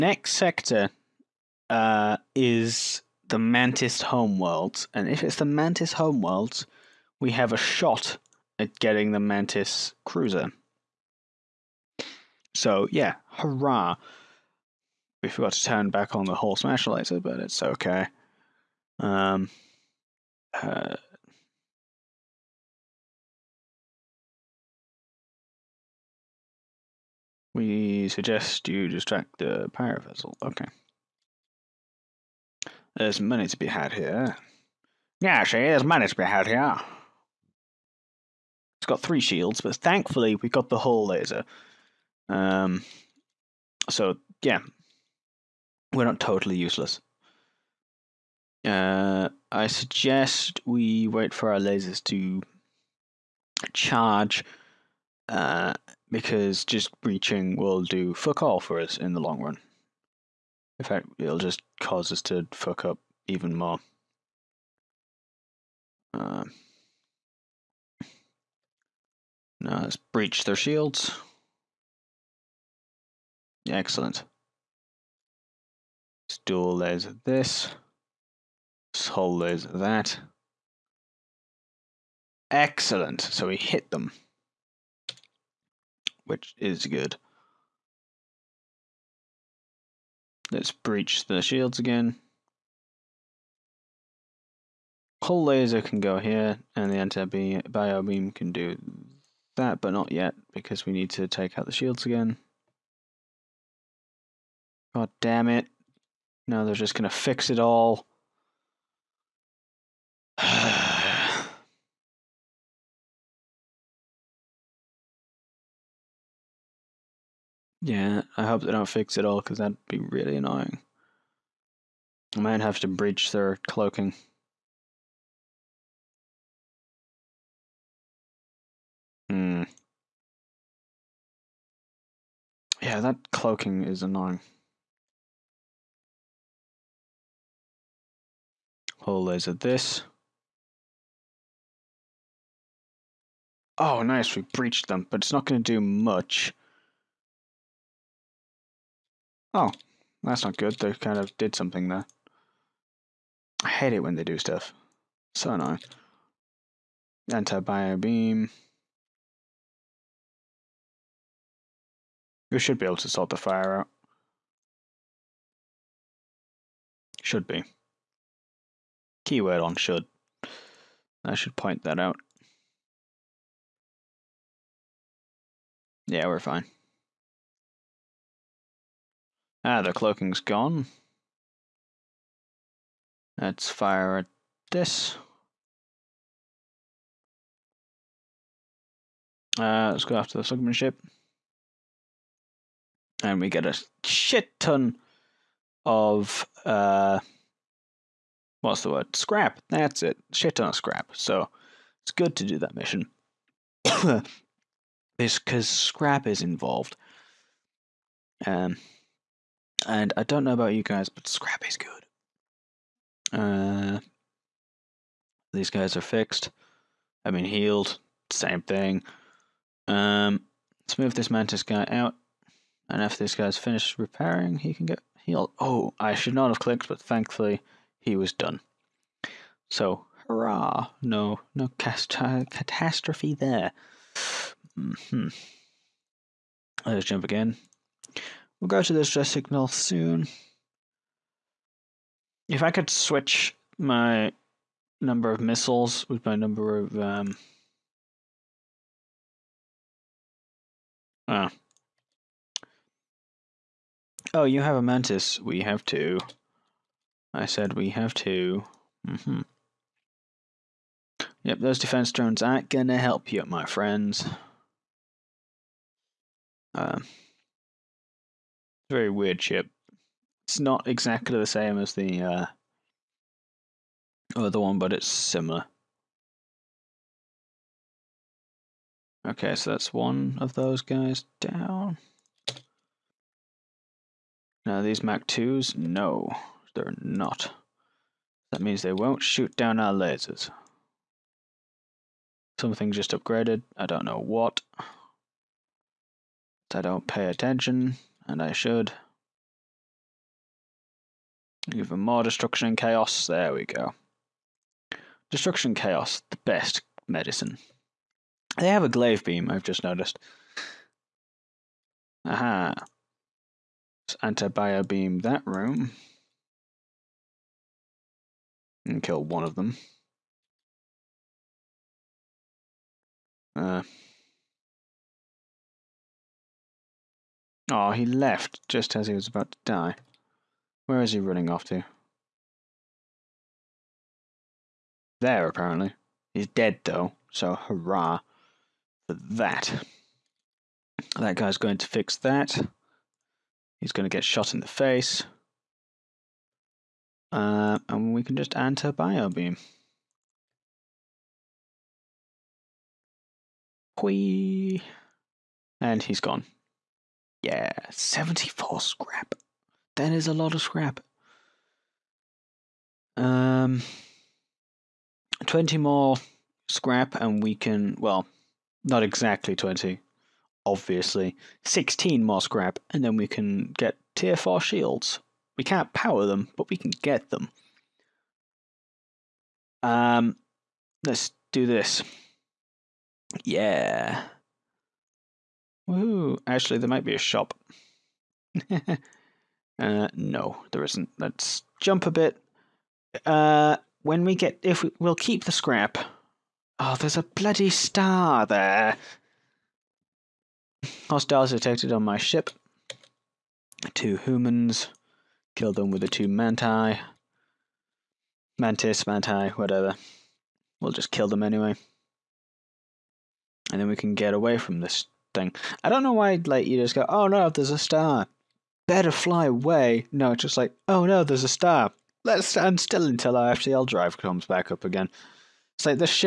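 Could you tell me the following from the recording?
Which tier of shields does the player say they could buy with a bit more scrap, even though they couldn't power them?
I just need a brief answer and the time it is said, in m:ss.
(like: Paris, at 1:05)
Tier 4, at 6:14.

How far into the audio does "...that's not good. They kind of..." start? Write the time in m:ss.
2:30.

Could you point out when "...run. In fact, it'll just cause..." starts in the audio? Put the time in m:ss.
0:59.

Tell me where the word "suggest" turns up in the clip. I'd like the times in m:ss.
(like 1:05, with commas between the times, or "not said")
0:28, 0:49.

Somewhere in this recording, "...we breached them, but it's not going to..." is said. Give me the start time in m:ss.
2:24.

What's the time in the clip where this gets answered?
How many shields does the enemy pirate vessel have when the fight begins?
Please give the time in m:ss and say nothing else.
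0:38.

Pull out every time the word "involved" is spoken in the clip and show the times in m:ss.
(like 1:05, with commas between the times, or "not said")
3:26.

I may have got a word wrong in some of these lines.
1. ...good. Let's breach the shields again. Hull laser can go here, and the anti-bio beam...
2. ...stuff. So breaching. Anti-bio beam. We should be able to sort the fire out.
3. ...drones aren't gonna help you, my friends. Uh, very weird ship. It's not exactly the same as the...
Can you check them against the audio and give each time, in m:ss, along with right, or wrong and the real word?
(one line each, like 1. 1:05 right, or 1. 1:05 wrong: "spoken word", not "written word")
1. 1:26 right
2. 2:34 wrong: "annoying", not "breaching"
3. 4:22 right.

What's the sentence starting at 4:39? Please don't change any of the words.
Okay, so that's one of those guys down.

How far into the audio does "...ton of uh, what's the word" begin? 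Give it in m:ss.
3:14.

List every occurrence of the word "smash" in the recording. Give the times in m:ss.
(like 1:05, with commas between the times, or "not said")
0:16.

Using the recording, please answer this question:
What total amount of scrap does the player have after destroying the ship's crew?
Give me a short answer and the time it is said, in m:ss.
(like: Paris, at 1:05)
74, at 5:57.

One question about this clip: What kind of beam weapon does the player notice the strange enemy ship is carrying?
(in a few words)
Glaive beam.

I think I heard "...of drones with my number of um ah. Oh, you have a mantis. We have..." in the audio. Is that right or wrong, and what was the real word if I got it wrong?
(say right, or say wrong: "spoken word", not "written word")
wrong: "missiles", not "drones".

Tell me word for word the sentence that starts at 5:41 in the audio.
That guy's going to fix that.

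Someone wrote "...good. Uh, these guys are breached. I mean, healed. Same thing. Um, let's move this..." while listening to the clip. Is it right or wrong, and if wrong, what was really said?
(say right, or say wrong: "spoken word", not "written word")
wrong: "fixed", not "breached".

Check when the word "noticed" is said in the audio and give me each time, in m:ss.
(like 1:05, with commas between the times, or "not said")
5:09.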